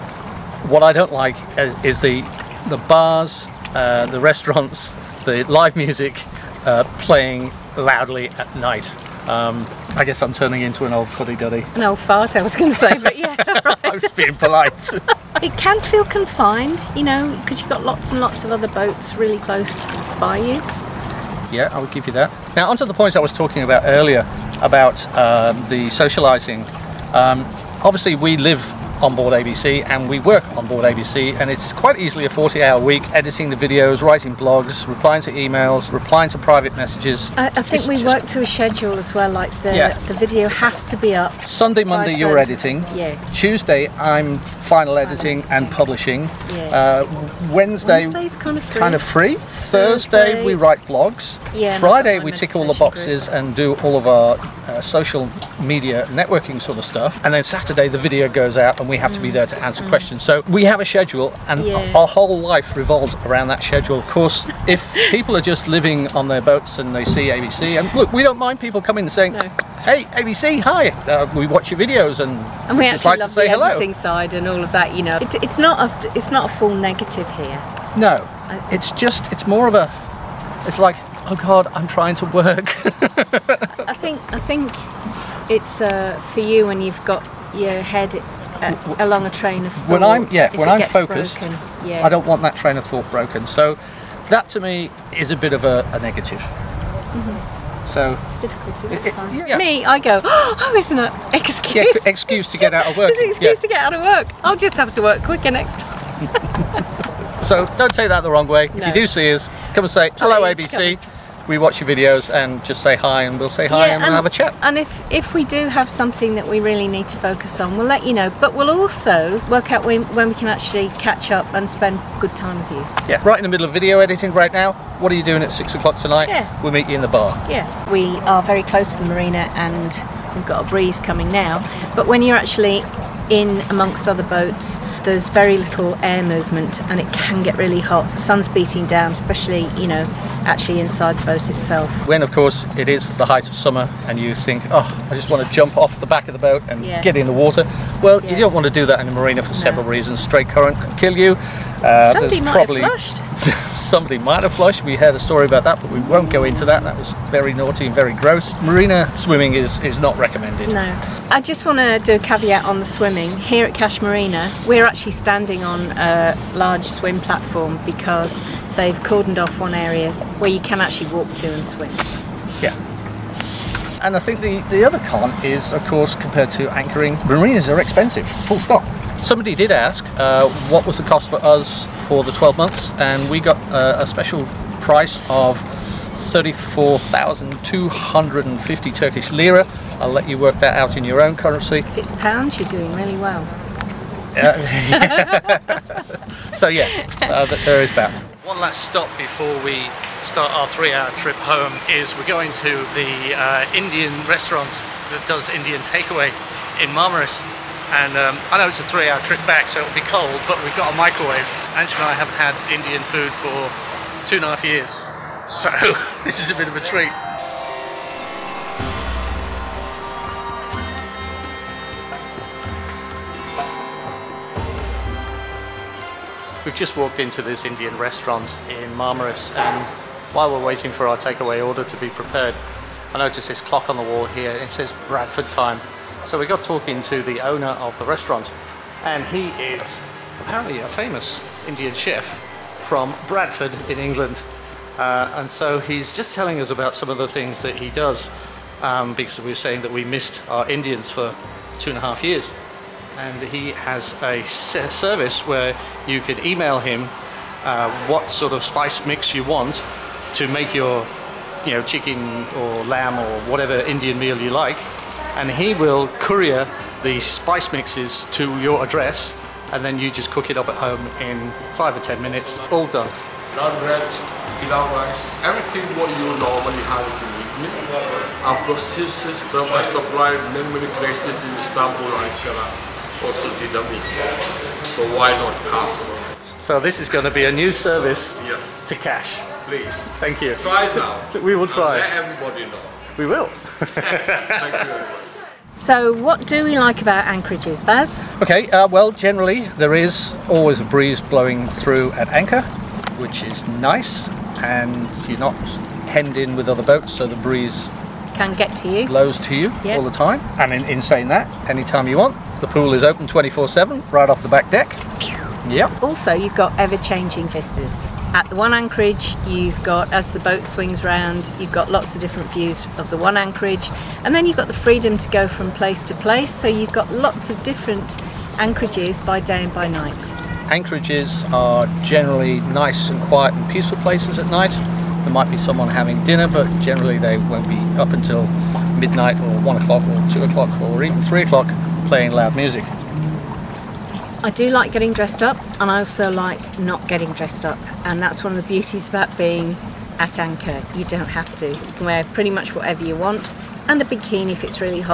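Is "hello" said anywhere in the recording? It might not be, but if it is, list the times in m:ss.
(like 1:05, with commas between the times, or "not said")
1:13, 1:50.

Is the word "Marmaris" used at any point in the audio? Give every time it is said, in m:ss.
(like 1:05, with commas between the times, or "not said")
3:26, 3:48.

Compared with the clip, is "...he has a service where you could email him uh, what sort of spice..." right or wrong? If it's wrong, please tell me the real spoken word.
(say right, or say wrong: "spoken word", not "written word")
right.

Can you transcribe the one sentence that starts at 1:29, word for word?
When I'm yeah, when I'm focused, broken, yeah.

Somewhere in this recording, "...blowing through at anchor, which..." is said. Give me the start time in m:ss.
5:01.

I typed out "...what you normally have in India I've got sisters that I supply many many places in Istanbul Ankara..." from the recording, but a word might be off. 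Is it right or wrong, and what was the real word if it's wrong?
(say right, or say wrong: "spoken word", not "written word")
right.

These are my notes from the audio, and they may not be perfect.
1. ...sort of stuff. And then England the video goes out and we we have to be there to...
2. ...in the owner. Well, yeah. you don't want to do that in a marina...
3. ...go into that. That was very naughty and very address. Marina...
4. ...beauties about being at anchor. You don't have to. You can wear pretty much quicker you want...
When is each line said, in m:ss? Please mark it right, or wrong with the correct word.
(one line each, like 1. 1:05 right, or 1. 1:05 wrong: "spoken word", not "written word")
1. 0:56 wrong: "Saturday", not "England"
2. 2:27 wrong: "water", not "owner"
3. 2:36 wrong: "gross", not "address"
4. 5:48 wrong: "whatever", not "quicker".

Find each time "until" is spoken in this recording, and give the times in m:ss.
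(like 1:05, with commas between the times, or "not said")
5:38.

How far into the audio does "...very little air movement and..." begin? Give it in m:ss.
2:15.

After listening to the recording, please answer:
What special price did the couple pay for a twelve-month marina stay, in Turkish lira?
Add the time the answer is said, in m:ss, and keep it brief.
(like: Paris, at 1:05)
34,250, at 3:06.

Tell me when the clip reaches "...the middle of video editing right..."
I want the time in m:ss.
2:03.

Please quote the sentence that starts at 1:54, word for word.
And if, if we do have something that we really need to focus on, we'll let you know.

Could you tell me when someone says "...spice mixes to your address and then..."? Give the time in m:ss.
4:27.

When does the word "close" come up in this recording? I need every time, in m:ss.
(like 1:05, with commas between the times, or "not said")
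0:19, 2:08.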